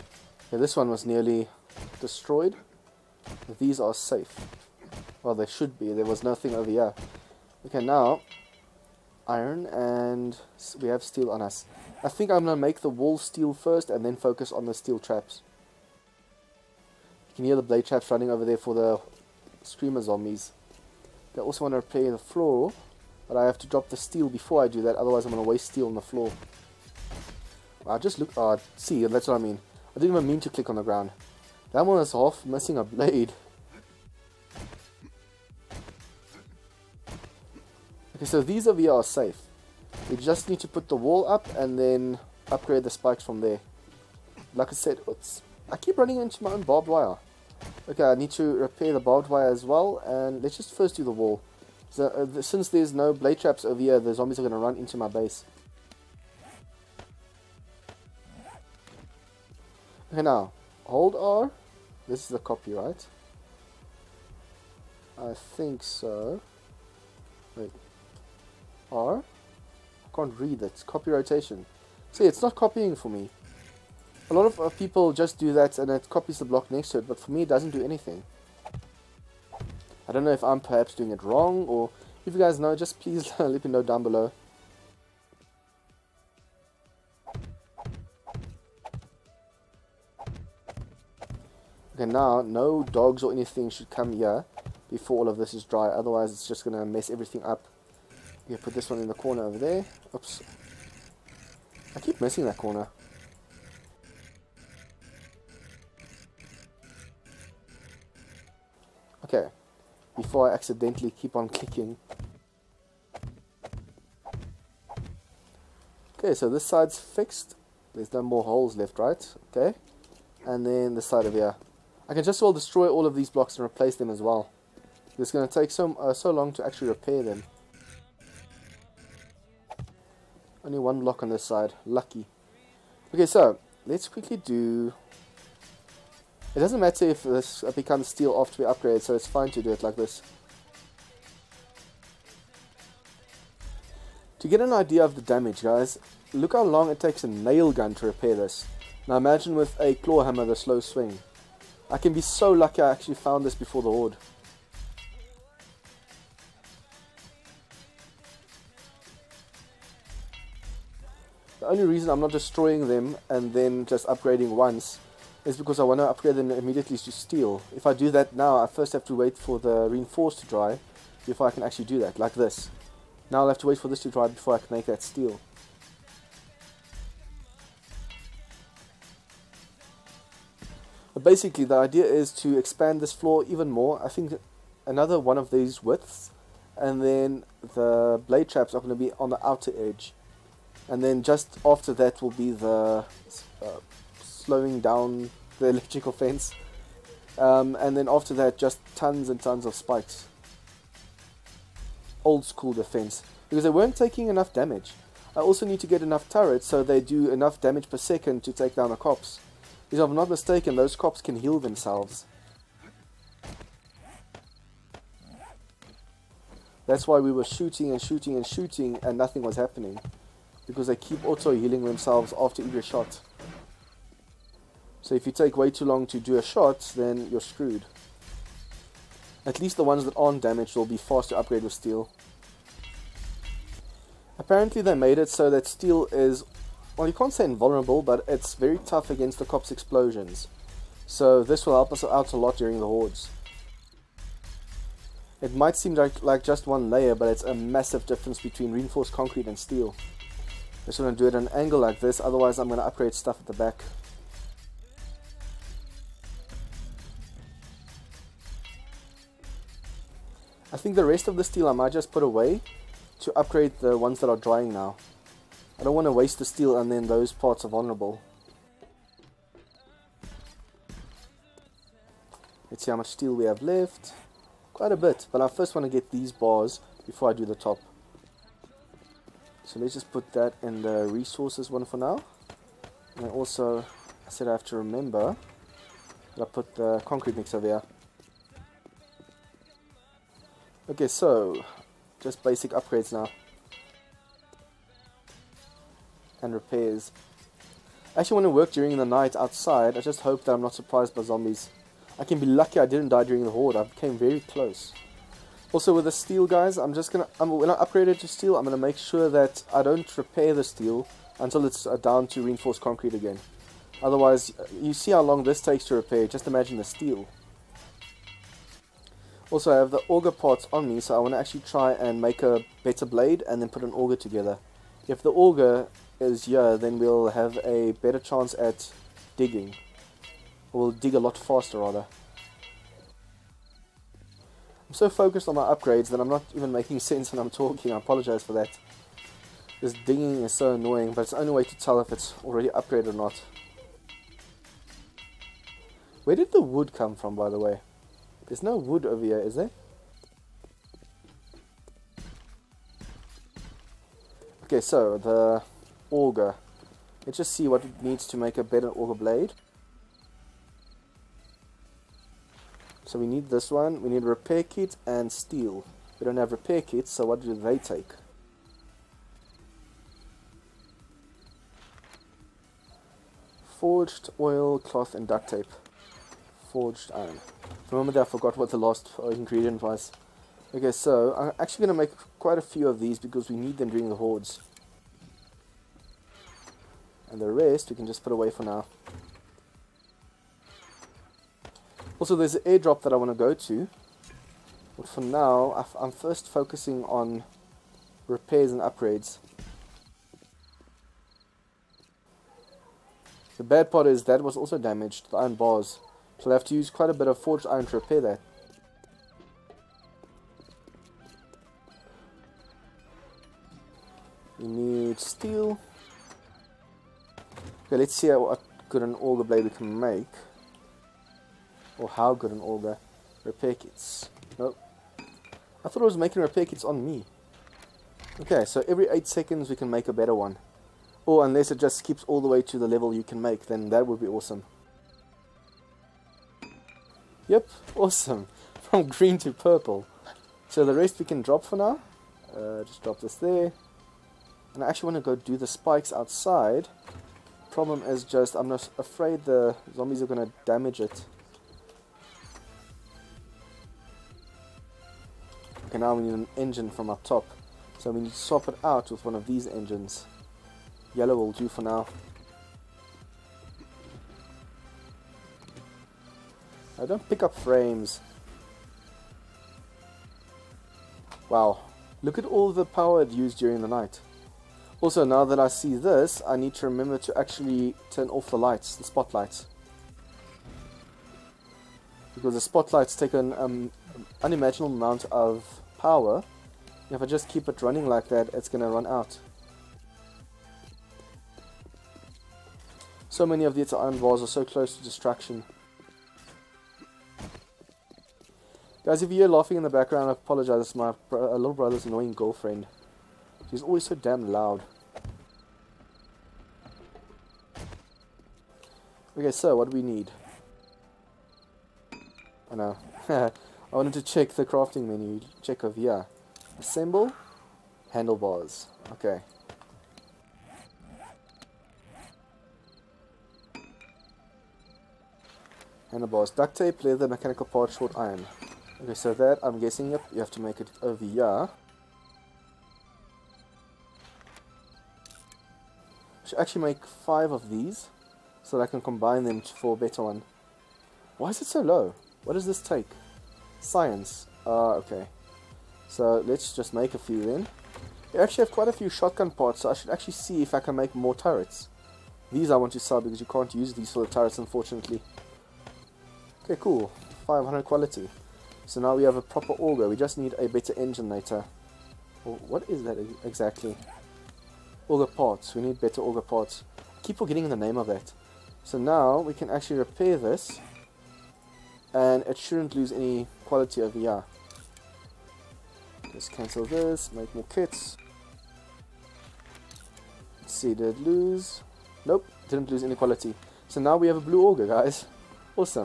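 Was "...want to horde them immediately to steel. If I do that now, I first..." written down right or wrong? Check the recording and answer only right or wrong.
wrong.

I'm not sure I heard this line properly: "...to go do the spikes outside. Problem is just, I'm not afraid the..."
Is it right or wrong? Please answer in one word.
right.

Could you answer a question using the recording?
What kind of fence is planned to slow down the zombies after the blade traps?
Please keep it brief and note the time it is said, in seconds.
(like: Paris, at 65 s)
electrical fence, at 195 s.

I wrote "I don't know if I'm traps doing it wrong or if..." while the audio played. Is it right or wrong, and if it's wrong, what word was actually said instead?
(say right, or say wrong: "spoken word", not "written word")
wrong: "perhaps", not "traps".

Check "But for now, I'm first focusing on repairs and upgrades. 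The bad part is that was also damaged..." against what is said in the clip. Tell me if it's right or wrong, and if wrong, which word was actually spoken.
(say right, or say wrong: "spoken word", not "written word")
right.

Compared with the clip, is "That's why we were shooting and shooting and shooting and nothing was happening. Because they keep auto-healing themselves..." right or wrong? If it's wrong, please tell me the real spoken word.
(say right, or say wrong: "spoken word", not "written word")
right.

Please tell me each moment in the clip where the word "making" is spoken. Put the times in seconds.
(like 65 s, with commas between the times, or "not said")
336 s, 426 s.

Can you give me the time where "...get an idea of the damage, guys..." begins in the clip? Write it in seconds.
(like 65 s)
144 s.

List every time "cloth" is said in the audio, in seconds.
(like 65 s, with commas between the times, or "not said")
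374 s.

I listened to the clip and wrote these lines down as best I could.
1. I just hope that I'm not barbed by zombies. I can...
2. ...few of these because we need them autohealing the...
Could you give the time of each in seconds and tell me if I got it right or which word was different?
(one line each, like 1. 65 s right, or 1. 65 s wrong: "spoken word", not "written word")
1. 299 s wrong: "surprised", not "barbed"
2. 382 s wrong: "during", not "autohealing".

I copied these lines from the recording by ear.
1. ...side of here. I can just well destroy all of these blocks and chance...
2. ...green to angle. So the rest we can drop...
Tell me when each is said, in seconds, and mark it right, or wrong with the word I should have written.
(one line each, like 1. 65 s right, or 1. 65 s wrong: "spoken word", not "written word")
1. 121 s wrong: "replace", not "chance"
2. 439 s wrong: "purple", not "angle".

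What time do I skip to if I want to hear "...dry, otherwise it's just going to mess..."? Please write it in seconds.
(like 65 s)
95 s.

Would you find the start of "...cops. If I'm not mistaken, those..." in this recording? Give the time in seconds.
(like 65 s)
208 s.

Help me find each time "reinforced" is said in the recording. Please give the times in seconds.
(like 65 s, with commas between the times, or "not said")
169 s, 248 s, 312 s.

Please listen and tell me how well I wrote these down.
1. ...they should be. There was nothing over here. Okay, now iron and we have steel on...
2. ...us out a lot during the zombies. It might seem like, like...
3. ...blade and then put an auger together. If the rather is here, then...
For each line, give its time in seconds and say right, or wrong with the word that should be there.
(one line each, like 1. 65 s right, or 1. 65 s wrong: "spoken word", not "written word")
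1. 5 s right
2. 241 s wrong: "hordes", not "zombies"
3. 323 s wrong: "auger", not "rather".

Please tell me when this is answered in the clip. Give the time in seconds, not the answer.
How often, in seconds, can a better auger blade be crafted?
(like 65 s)
428 s.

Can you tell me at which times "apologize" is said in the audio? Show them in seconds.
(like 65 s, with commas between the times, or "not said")
337 s, 500 s.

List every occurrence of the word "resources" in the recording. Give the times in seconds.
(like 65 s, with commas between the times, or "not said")
281 s.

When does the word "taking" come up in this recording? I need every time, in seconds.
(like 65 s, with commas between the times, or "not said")
203 s.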